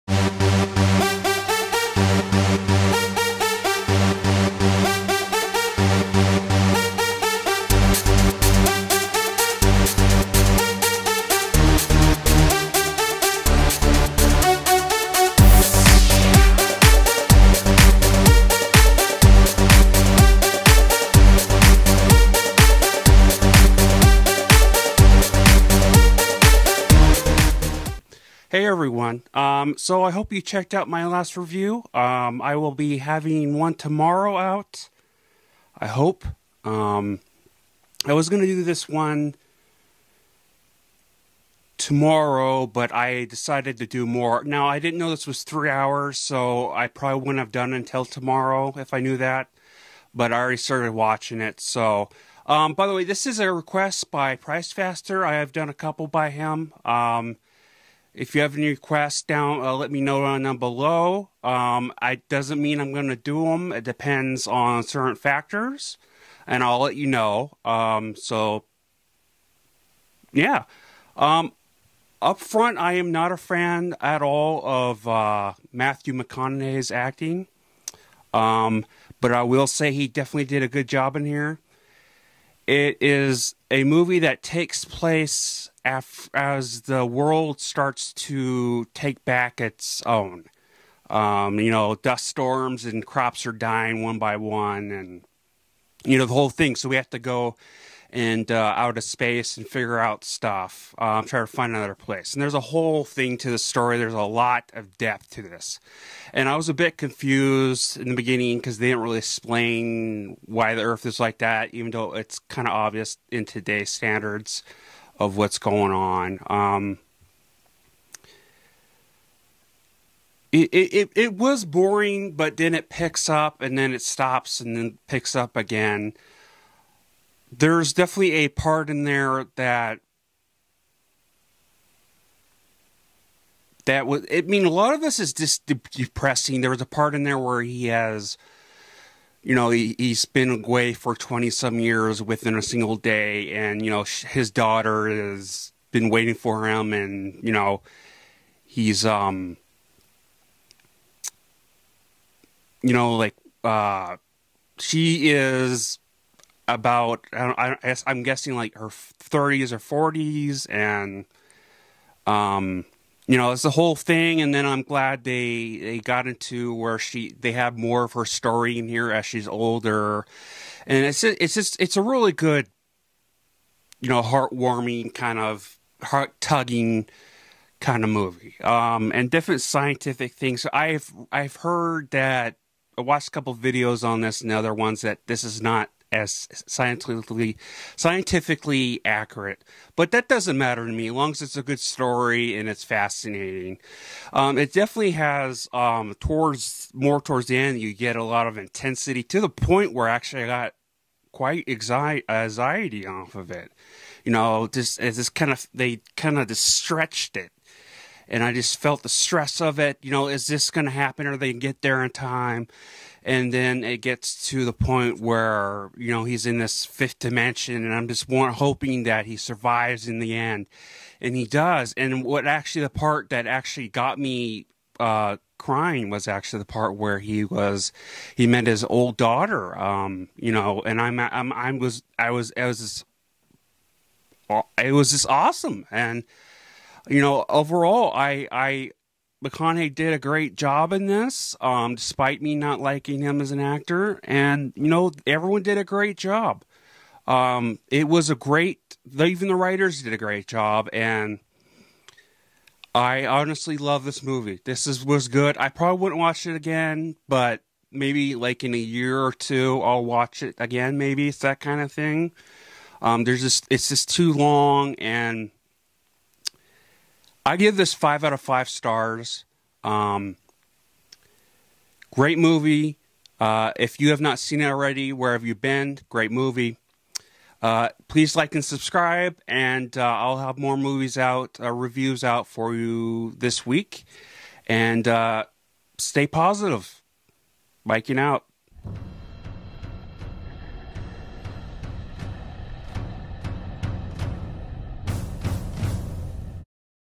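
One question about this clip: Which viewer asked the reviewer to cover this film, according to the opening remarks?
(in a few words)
Price Faster.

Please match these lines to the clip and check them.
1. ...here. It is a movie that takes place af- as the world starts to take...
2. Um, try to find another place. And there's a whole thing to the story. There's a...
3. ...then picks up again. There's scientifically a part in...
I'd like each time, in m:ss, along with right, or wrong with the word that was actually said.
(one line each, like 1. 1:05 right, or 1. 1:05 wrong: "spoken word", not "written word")
1. 1:21 right
2. 1:40 right
3. 2:04 wrong: "definitely", not "scientifically".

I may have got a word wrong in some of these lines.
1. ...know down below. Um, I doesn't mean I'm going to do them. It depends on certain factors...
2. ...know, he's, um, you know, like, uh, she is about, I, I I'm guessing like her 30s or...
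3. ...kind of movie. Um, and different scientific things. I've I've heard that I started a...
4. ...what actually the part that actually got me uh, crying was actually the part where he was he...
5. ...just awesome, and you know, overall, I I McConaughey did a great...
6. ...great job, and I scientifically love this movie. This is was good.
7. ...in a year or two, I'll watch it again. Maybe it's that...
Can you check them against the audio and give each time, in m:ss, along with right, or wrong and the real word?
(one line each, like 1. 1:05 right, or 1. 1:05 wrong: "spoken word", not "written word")
1. 1:00 right
2. 2:27 right
3. 2:57 wrong: "watched", not "started"
4. 3:42 right
5. 3:55 right
6. 4:10 wrong: "honestly", not "scientifically"
7. 4:18 right.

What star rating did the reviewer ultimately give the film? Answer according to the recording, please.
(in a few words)
5 out of 5.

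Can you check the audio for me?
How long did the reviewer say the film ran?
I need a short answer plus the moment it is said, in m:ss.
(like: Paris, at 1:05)
3 hours, at 0:45.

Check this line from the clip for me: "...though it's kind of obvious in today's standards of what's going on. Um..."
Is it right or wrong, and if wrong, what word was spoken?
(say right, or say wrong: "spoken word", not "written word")
right.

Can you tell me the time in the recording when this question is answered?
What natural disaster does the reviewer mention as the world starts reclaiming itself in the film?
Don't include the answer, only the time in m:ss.
1:31.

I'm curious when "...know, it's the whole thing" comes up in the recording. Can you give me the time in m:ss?
2:43.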